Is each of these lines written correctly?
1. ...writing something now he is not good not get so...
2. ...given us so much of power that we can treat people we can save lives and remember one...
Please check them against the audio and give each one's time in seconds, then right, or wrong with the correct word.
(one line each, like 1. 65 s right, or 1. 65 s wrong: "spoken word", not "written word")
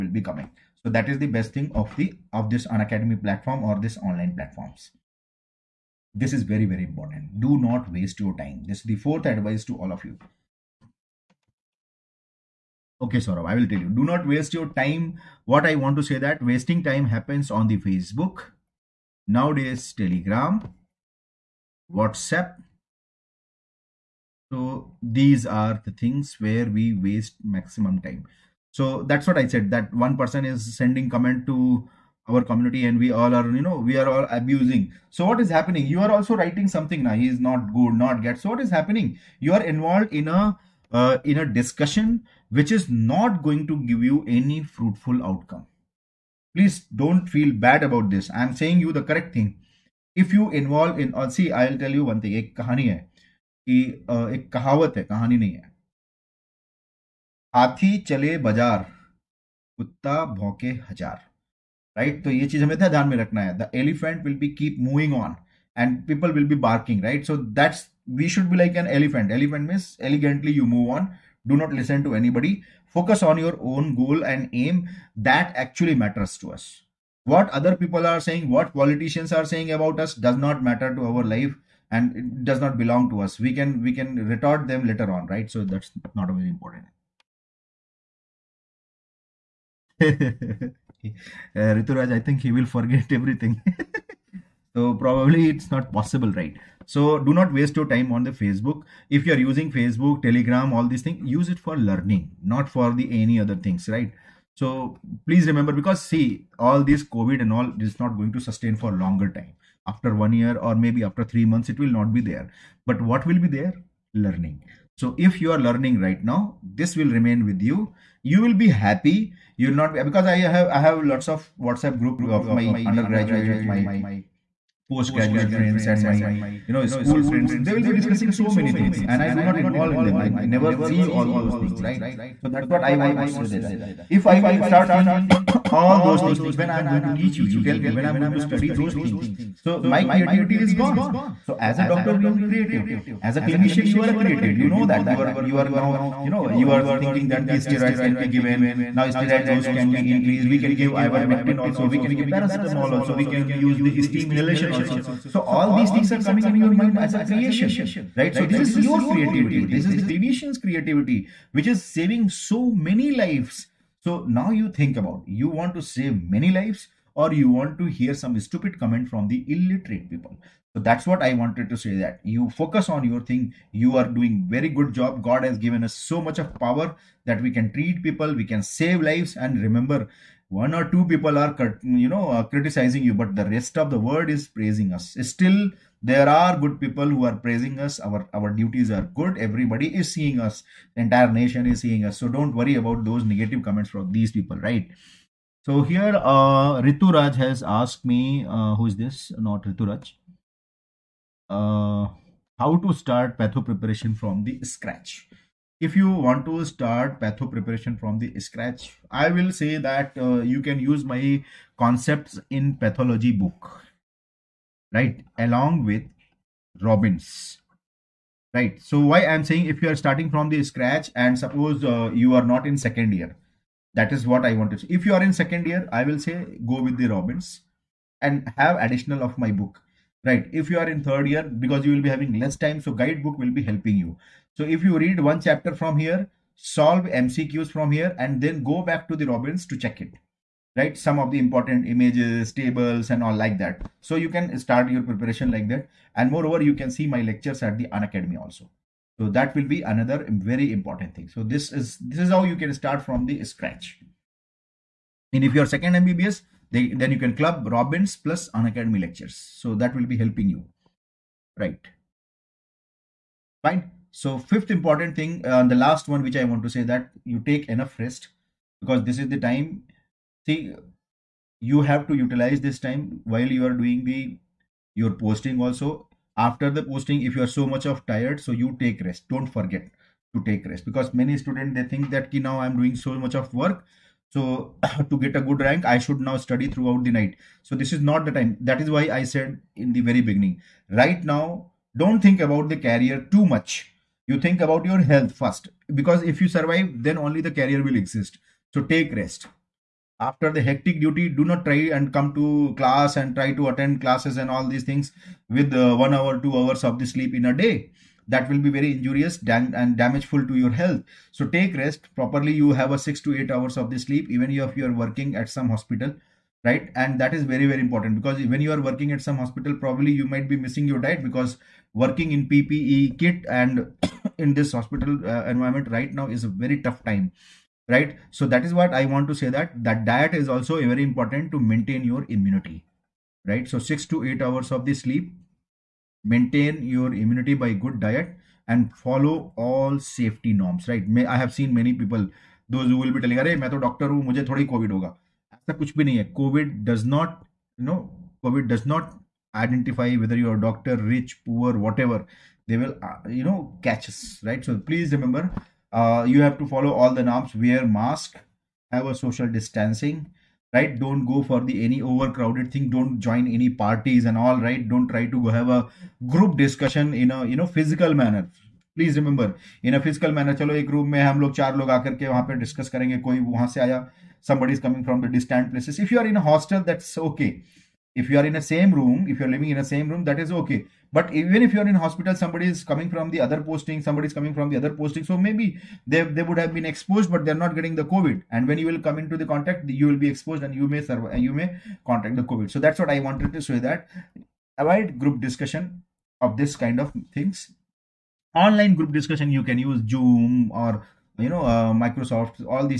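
1. 36 s right
2. 175 s right.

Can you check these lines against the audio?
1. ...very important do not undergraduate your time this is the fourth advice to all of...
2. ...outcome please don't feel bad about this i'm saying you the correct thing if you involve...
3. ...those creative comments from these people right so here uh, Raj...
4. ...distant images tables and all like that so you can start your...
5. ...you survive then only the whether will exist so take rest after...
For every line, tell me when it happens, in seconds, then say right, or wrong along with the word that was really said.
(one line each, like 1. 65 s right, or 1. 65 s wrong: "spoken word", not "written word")
1. 6 s wrong: "waste", not "undergraduate"
2. 45 s right
3. 193 s wrong: "negative", not "creative"
4. 241 s wrong: "important", not "distant"
5. 296 s wrong: "career", not "whether".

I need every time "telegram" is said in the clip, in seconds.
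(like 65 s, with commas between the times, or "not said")
19 s, 100 s.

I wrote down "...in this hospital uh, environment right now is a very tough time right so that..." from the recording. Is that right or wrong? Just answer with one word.
right.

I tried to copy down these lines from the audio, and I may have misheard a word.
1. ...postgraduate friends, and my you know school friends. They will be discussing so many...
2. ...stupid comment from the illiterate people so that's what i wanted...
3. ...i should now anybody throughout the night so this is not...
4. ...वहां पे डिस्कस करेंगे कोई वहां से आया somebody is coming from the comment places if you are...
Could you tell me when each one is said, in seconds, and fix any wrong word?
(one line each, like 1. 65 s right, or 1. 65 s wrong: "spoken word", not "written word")
1. 124 s right
2. 168 s right
3. 285 s wrong: "study", not "anybody"
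4. 372 s wrong: "distant", not "comment".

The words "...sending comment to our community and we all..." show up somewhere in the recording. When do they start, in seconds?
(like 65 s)
30 s.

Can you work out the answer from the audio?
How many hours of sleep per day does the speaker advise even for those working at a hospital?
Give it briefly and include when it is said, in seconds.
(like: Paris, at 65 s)
6 to 8 hours, at 312 s.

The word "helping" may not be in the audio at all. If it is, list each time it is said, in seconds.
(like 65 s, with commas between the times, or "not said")
233 s, 260 s.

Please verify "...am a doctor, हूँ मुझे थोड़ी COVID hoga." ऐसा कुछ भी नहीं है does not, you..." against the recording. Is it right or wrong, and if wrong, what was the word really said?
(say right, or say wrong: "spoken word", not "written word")
right.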